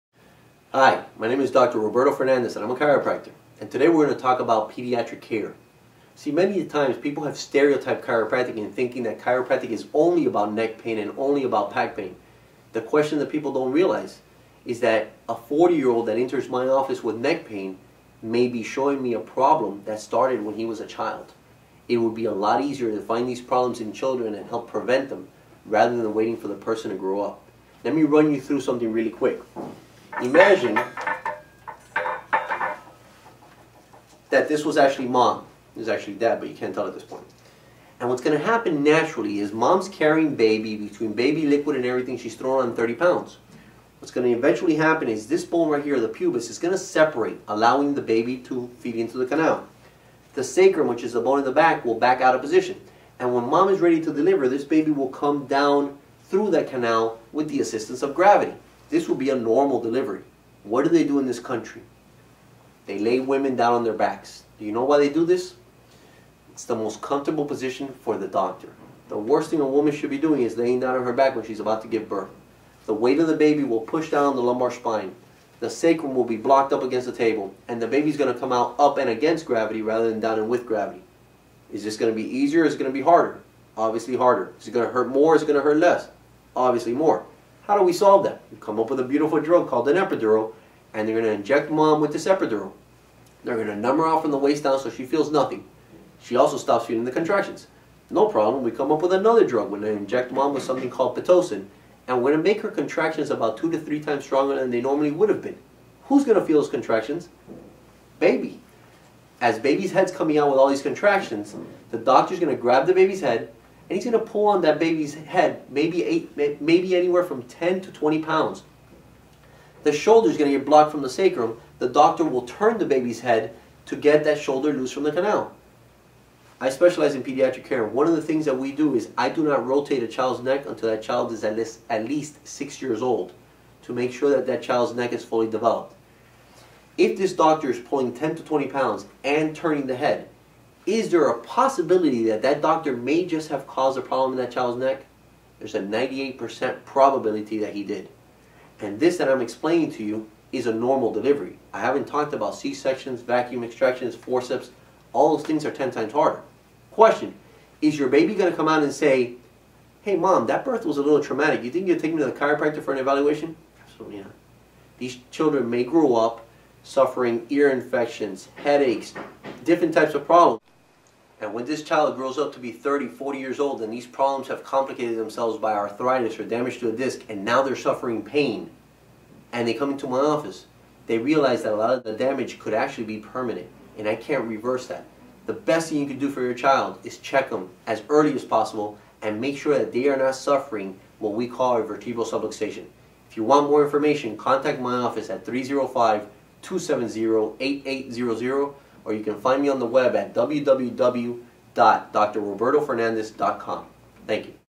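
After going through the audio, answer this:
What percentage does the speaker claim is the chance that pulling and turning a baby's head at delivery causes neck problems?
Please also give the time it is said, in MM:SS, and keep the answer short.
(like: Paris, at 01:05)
98%, at 02:25.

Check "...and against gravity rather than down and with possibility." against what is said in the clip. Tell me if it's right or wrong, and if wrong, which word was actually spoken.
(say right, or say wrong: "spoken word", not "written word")
wrong: "gravity", not "possibility".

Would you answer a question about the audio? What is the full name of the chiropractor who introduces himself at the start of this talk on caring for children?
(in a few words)
Roberto Fernandez.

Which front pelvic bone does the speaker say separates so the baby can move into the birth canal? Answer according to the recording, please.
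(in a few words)
Pubis.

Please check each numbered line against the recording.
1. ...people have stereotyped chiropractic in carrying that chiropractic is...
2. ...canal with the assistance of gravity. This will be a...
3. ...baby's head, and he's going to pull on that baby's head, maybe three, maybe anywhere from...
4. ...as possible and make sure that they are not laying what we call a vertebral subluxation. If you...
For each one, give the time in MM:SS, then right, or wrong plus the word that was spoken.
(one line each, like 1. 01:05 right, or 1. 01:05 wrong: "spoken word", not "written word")
1. 00:06 wrong: "thinking", not "carrying"
2. 00:56 right
3. 01:52 wrong: "eight", not "three"
4. 03:08 wrong: "suffering", not "laying".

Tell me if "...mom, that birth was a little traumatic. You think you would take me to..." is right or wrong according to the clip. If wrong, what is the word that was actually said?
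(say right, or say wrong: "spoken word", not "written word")
right.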